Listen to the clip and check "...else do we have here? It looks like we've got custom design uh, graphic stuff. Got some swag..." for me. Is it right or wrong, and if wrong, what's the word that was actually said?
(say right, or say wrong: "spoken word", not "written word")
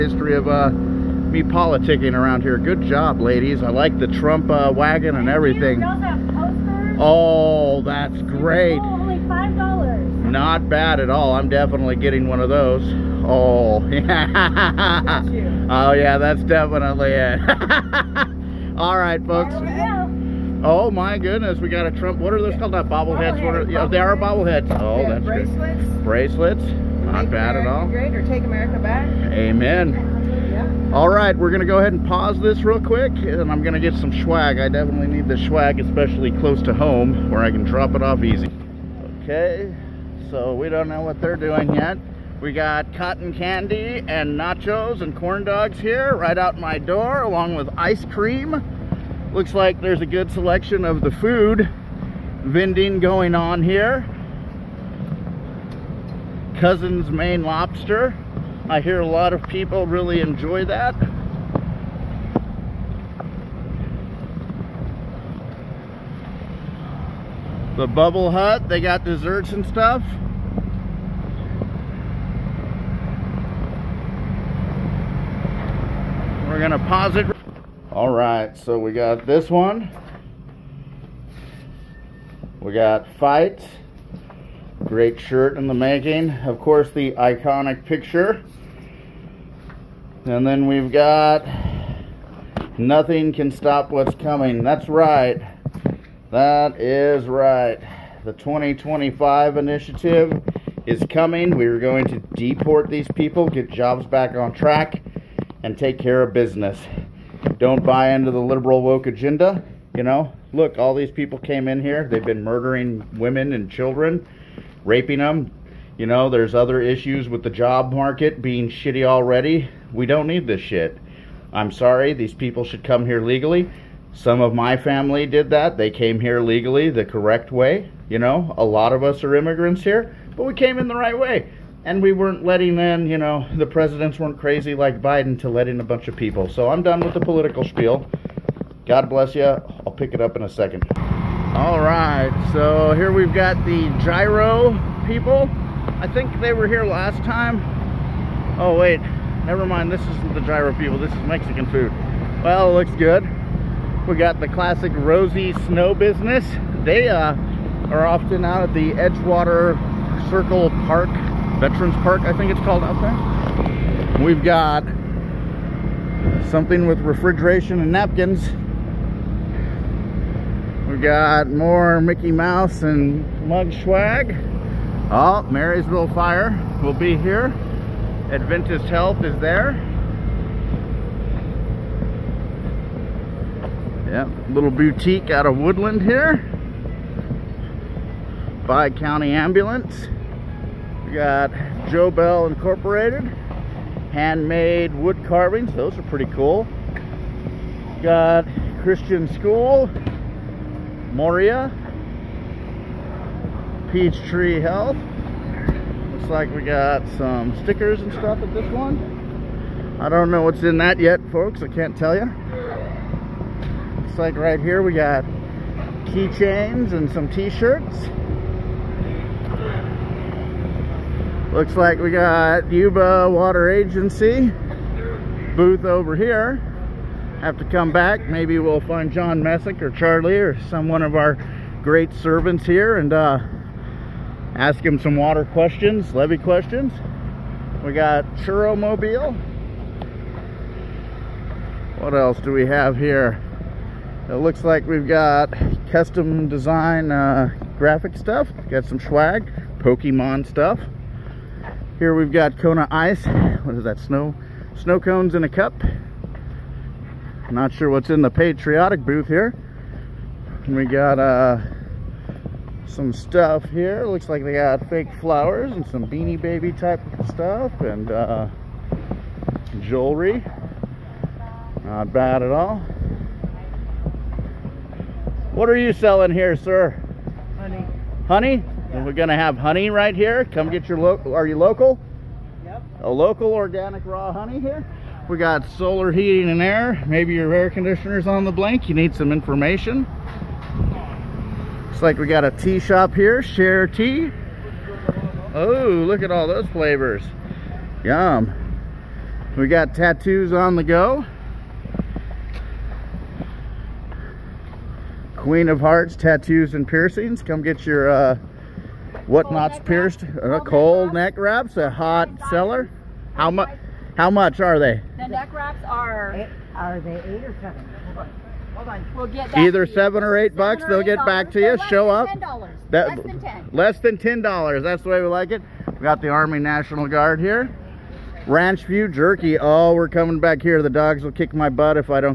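right.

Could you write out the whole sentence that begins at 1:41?
We are going to deport these people, get jobs back on track, and take care of business.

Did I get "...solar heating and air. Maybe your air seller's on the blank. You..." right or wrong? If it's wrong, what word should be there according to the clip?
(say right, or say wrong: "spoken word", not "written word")
wrong: "conditioner", not "seller".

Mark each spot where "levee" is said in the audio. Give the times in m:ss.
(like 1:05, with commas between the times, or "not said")
3:56.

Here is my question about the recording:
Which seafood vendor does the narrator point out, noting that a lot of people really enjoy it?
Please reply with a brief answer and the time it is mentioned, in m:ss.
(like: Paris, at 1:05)
Cousin's Maine Lobster, at 0:56.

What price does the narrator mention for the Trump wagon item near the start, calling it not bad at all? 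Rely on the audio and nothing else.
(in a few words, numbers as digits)
$5.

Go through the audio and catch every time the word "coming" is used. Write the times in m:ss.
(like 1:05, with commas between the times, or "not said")
1:34, 1:41, 5:30.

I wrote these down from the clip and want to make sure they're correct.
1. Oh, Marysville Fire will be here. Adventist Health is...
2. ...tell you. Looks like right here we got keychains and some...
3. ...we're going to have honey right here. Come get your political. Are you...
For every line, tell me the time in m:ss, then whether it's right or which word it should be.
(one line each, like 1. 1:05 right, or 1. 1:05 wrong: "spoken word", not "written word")
1. 2:55 right
2. 3:31 right
3. 4:39 wrong: "local", not "political".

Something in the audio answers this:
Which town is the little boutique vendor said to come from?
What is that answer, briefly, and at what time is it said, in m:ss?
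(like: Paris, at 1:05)
Woodland, at 3:05.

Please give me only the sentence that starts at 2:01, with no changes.
I'm sorry, these people should come here legally.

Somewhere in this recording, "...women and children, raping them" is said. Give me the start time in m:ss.
1:53.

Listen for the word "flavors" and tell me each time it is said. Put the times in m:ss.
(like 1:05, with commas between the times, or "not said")
4:56.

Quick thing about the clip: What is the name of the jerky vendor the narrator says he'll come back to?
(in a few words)
Ranch View Jerky.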